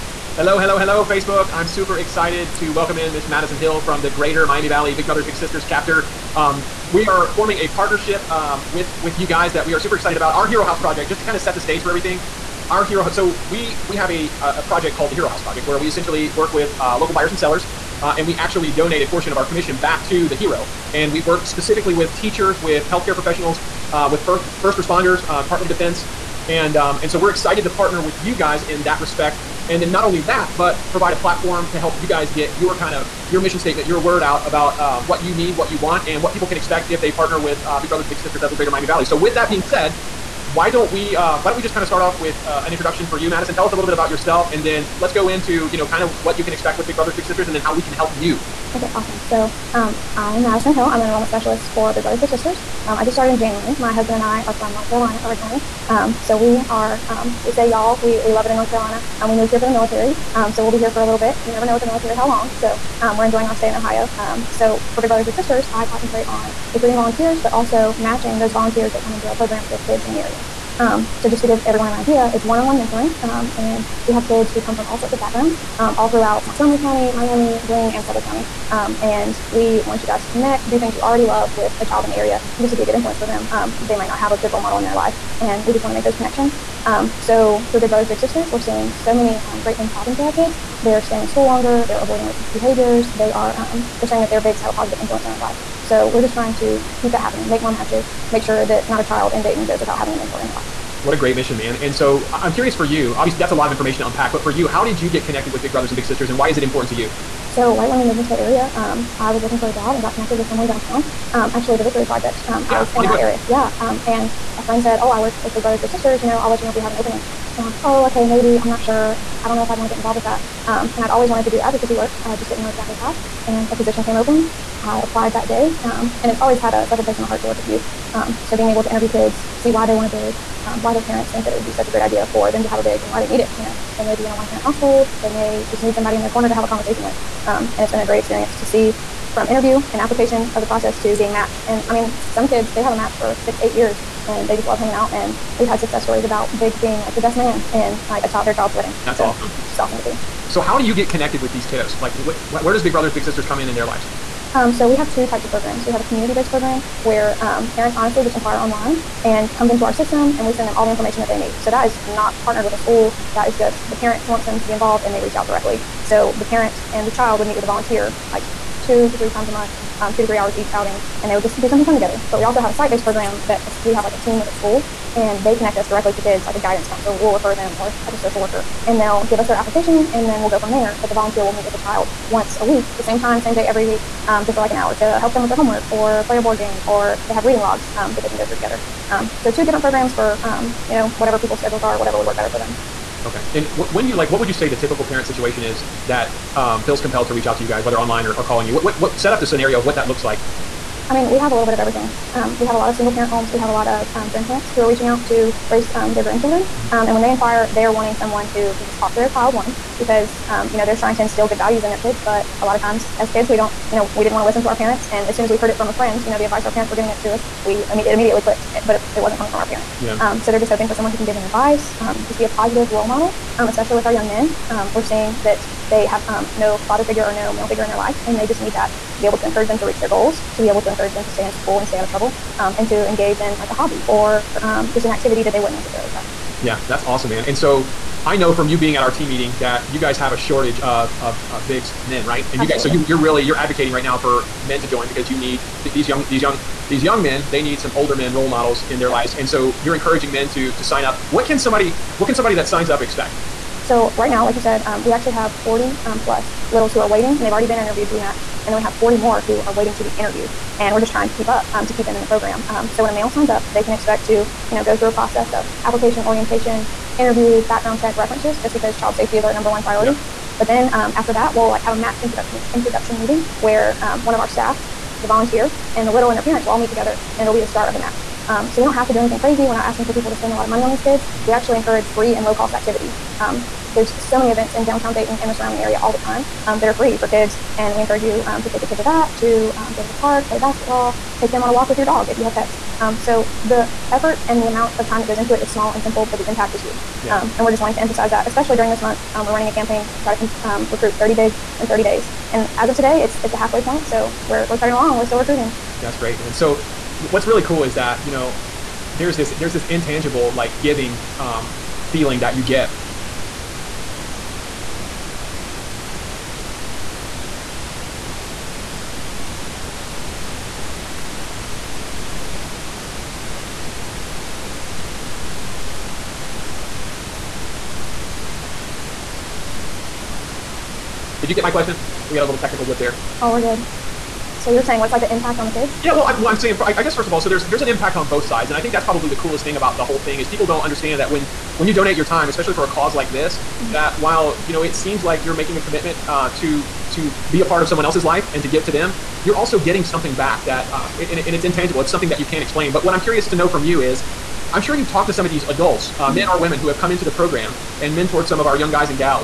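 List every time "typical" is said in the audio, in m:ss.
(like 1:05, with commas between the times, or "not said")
3:14.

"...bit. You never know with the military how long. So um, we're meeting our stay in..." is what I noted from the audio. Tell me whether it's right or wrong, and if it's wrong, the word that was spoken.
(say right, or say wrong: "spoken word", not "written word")
wrong: "enjoying", not "meeting".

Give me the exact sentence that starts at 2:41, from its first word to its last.
So that is not partnered with a school.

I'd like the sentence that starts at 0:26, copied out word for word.
And, um, and so we're excited to partner with you guys in that respect.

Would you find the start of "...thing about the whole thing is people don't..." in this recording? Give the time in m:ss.
5:39.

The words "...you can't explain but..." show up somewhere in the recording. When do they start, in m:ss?
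5:52.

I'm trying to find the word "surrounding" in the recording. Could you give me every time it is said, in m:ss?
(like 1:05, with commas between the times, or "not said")
4:45.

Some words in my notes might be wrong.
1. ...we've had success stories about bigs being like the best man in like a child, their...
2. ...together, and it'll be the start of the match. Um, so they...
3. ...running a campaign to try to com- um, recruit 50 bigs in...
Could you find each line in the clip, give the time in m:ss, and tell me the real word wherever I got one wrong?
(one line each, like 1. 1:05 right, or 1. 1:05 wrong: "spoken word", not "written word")
1. 2:25 right
2. 4:36 right
3. 4:59 wrong: "30", not "50".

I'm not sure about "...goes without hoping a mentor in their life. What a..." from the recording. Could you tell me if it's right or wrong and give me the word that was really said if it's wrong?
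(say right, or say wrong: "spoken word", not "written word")
wrong: "having", not "hoping".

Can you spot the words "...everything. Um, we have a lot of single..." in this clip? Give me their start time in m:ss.
3:21.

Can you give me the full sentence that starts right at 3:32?
But a lot of times as kids, we don't, you know, we didn't want to listen to our parents.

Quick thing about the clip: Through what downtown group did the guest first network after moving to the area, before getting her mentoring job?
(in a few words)
Victory Project.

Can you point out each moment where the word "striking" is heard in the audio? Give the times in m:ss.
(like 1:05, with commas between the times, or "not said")
not said.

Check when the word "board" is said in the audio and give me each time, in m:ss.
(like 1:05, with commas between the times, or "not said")
3:06.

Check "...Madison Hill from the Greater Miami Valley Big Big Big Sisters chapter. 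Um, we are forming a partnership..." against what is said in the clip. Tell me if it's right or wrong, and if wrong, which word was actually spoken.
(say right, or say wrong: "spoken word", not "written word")
wrong: "Brothers", not "Big".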